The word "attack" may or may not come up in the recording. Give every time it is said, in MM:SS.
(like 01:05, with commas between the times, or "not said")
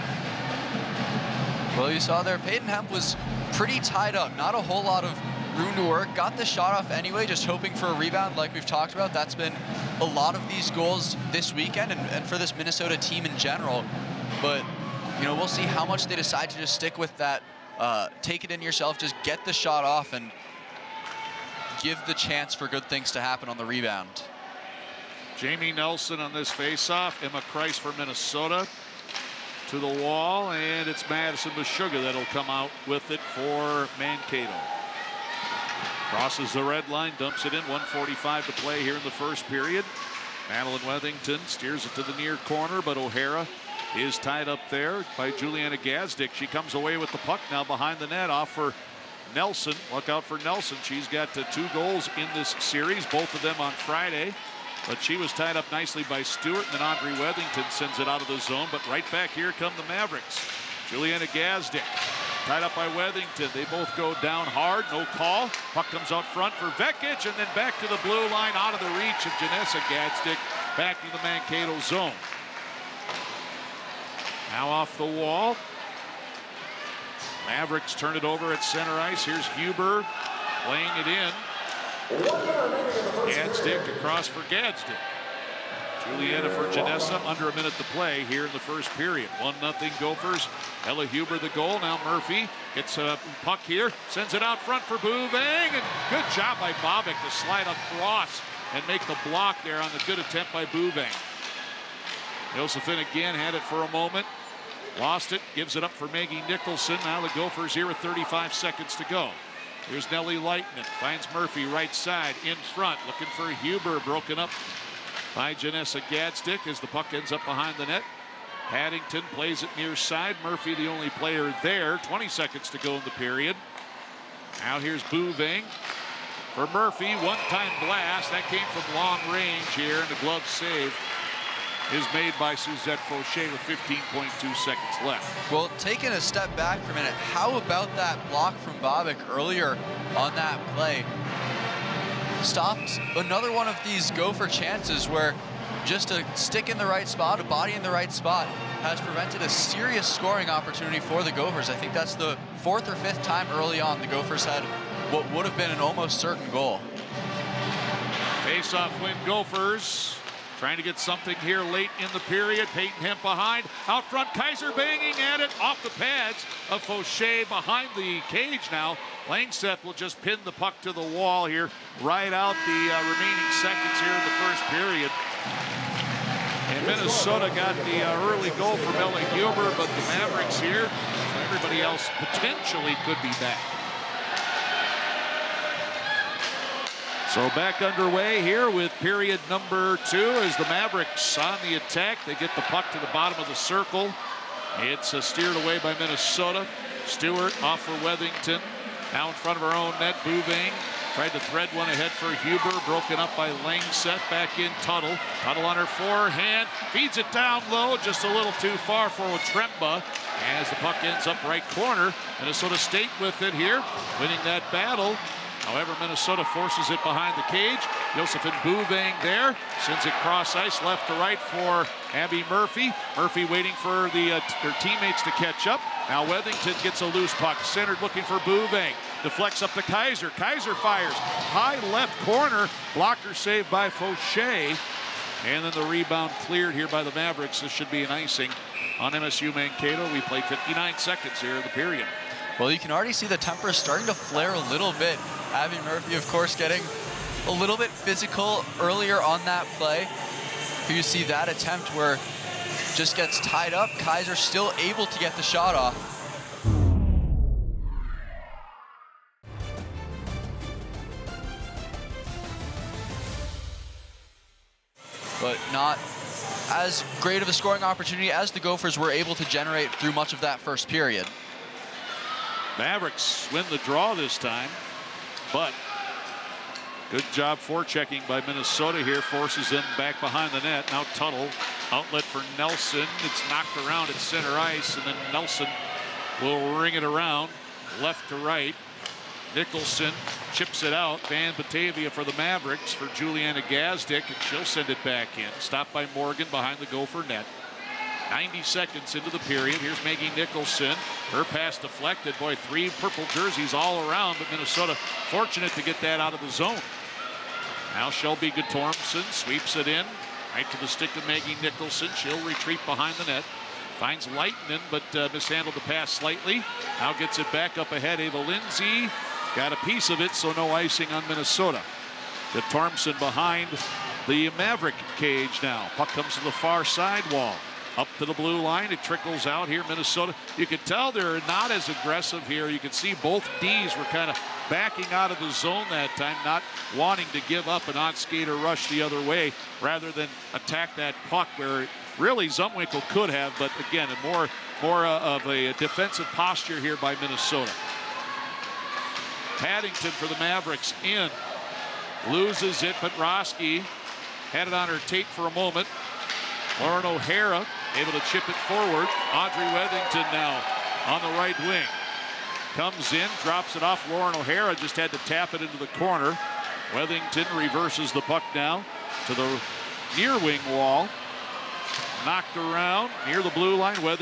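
03:11, 05:40.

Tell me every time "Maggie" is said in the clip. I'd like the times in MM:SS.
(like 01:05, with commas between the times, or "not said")
01:46, 05:00, 05:11.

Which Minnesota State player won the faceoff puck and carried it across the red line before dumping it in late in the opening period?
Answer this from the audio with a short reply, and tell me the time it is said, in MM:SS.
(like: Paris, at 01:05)
Madison Mashuga, at 00:31.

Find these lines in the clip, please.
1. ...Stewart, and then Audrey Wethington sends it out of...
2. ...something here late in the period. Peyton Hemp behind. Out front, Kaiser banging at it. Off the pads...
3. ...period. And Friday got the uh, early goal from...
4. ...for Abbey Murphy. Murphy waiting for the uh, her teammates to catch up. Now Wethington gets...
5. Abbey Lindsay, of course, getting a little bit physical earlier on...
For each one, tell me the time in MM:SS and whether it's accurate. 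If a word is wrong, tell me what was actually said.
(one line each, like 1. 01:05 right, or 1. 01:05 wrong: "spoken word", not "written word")
1. 00:56 right
2. 02:40 right
3. 02:54 wrong: "Minnesota", not "Friday"
4. 03:41 right
5. 04:05 wrong: "Murphy", not "Lindsay".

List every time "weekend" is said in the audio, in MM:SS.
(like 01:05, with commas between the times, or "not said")
00:11.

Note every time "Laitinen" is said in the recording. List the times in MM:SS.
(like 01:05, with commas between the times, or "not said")
01:50, 05:14.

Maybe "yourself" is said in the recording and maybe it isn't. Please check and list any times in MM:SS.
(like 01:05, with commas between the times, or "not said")
00:18.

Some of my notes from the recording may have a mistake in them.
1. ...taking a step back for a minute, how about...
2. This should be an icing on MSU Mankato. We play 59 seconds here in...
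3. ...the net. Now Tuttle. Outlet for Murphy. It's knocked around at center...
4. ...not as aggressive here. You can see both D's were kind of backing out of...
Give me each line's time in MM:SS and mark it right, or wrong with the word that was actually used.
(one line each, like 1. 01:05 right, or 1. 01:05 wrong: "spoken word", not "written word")
1. 02:15 right
2. 03:57 right
3. 04:40 wrong: "Nelson", not "Murphy"
4. 05:31 right.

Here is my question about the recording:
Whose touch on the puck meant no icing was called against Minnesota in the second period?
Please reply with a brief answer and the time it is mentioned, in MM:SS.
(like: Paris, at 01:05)
Ava Lindsay, at 05:18.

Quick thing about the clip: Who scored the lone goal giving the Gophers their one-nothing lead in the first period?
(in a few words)
Ella Huber.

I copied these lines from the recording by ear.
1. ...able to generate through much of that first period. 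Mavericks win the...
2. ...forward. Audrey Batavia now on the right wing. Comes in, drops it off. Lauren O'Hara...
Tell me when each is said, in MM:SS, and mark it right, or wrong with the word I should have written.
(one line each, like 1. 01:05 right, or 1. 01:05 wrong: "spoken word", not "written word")
1. 04:29 right
2. 05:58 wrong: "Wethington", not "Batavia".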